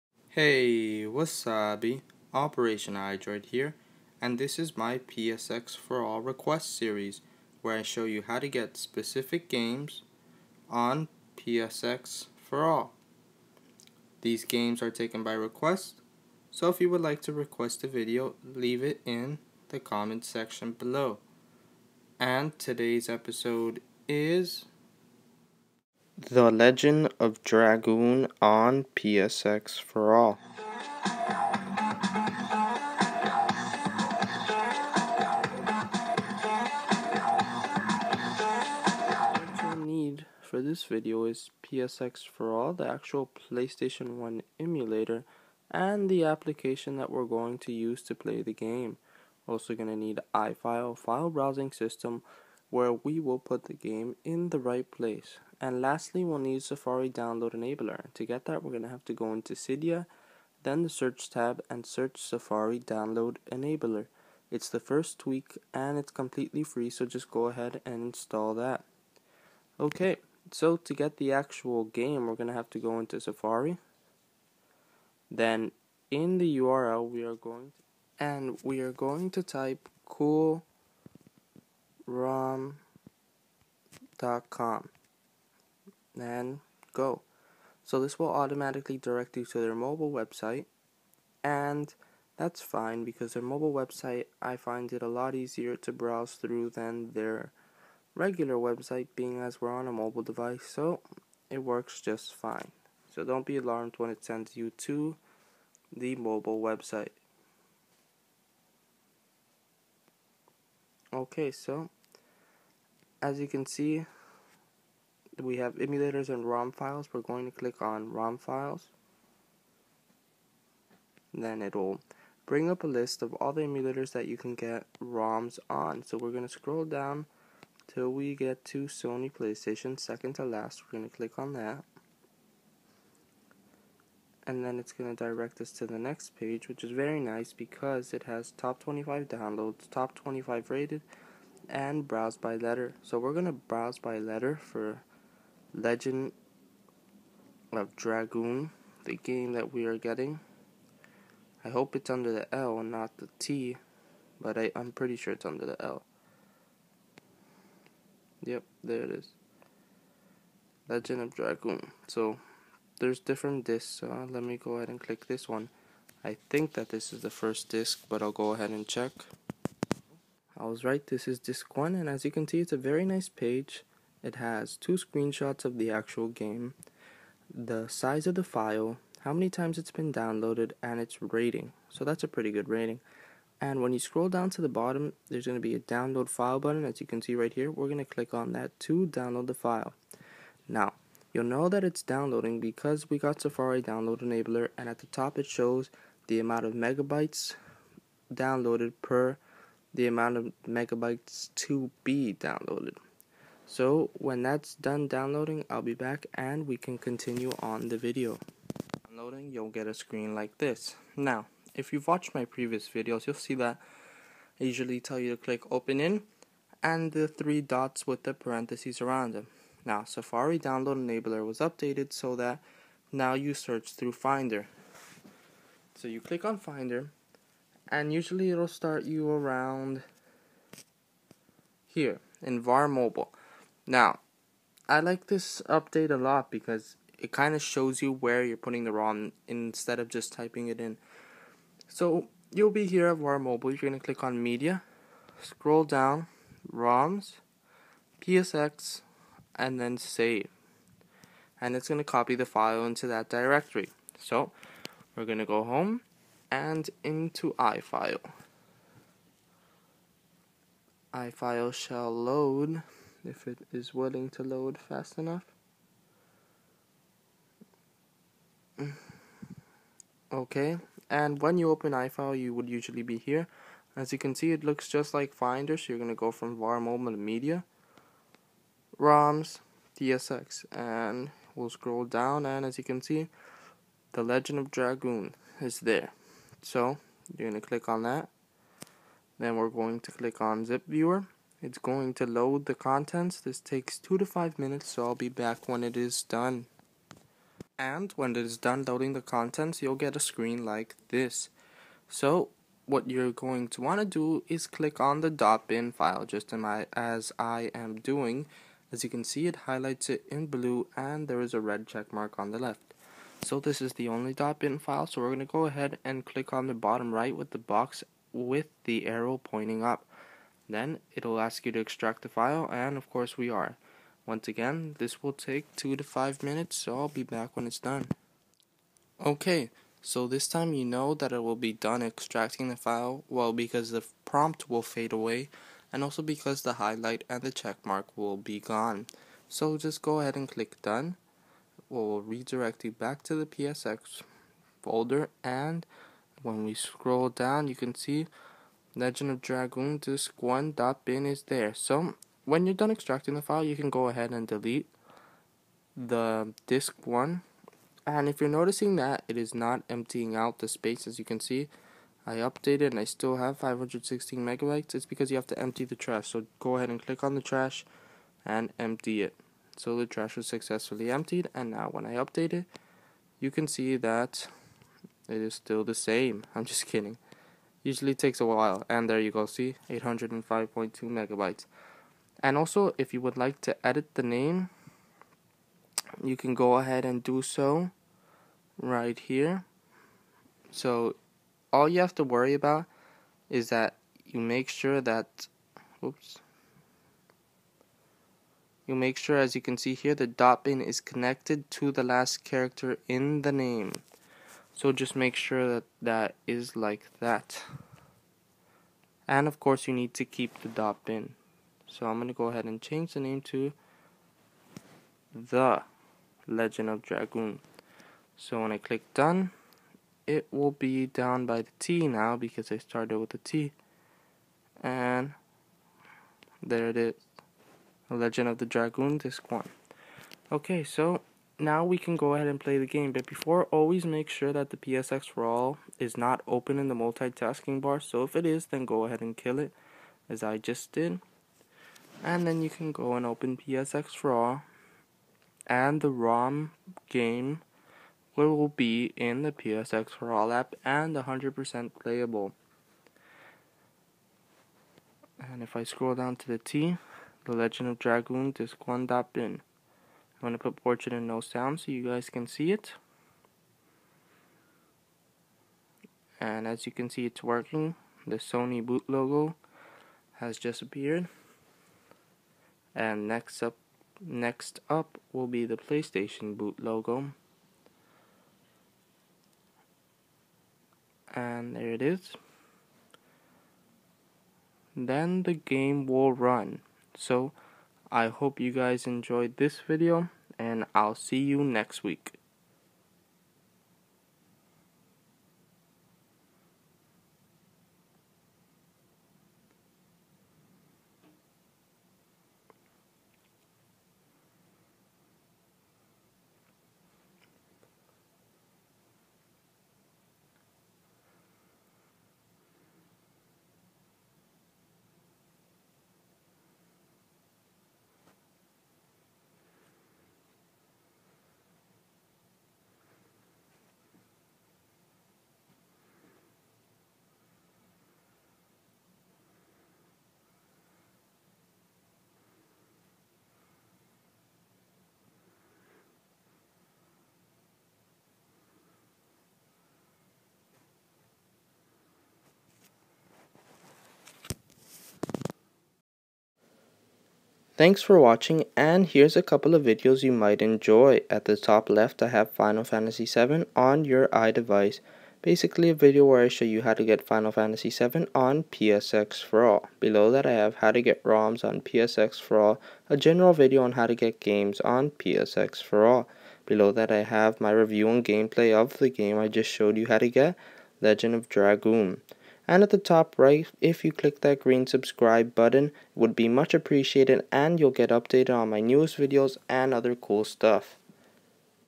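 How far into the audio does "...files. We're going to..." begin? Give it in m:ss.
1:56.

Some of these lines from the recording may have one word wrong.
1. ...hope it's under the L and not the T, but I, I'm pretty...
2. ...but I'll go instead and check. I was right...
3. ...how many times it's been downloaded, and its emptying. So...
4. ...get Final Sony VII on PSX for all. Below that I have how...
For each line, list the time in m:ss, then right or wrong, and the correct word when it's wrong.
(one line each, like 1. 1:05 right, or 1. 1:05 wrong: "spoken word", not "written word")
1. 2:31 right
2. 2:48 wrong: "ahead", not "instead"
3. 2:59 wrong: "rating", not "emptying"
4. 9:17 wrong: "Fantasy", not "Sony".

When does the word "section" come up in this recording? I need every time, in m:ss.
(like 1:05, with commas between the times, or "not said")
0:20.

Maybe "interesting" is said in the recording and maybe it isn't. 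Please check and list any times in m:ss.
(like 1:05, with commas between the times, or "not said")
not said.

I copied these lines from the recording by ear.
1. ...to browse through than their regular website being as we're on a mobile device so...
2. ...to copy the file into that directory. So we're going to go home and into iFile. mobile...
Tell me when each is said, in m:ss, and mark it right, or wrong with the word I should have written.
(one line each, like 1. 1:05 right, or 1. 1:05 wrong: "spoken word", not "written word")
1. 1:35 right
2. 4:11 wrong: "iFile", not "mobile".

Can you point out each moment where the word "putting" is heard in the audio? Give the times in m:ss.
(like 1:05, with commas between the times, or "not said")
3:58.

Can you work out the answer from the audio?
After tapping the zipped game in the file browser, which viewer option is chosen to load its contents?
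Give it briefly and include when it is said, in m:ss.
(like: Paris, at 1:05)
Zip Viewer, at 4:50.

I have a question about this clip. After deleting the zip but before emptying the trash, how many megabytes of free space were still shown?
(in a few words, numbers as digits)
516 megabytes.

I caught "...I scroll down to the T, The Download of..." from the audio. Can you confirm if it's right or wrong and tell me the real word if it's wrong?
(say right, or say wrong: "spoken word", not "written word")
wrong: "Legend", not "Download".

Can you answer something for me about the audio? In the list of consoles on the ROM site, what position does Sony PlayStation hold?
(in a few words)
Second to last.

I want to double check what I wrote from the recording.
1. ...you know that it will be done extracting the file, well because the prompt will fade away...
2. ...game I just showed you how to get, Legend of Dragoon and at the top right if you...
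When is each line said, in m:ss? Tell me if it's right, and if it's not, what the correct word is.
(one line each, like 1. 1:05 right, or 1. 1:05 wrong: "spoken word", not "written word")
1. 5:30 right
2. 9:29 right.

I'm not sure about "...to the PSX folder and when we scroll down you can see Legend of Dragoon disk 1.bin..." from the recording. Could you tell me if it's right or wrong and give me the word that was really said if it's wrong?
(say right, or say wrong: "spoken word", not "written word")
right.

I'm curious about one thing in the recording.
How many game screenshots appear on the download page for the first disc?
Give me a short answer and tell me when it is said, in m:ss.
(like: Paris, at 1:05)
2, at 2:54.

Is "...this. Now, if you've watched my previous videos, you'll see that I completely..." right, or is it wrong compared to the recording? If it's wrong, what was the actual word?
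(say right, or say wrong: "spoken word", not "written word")
wrong: "usually", not "completely".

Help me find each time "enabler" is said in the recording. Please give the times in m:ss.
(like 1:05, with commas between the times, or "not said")
0:57, 1:03, 3:14, 3:40.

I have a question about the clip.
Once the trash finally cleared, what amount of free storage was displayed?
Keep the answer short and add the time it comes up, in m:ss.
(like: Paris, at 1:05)
805.2 megabytes, at 6:19.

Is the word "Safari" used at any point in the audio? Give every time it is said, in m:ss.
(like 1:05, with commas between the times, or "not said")
0:56, 1:02, 1:13, 3:13, 3:40.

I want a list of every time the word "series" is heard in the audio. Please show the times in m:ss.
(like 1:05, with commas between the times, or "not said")
0:06.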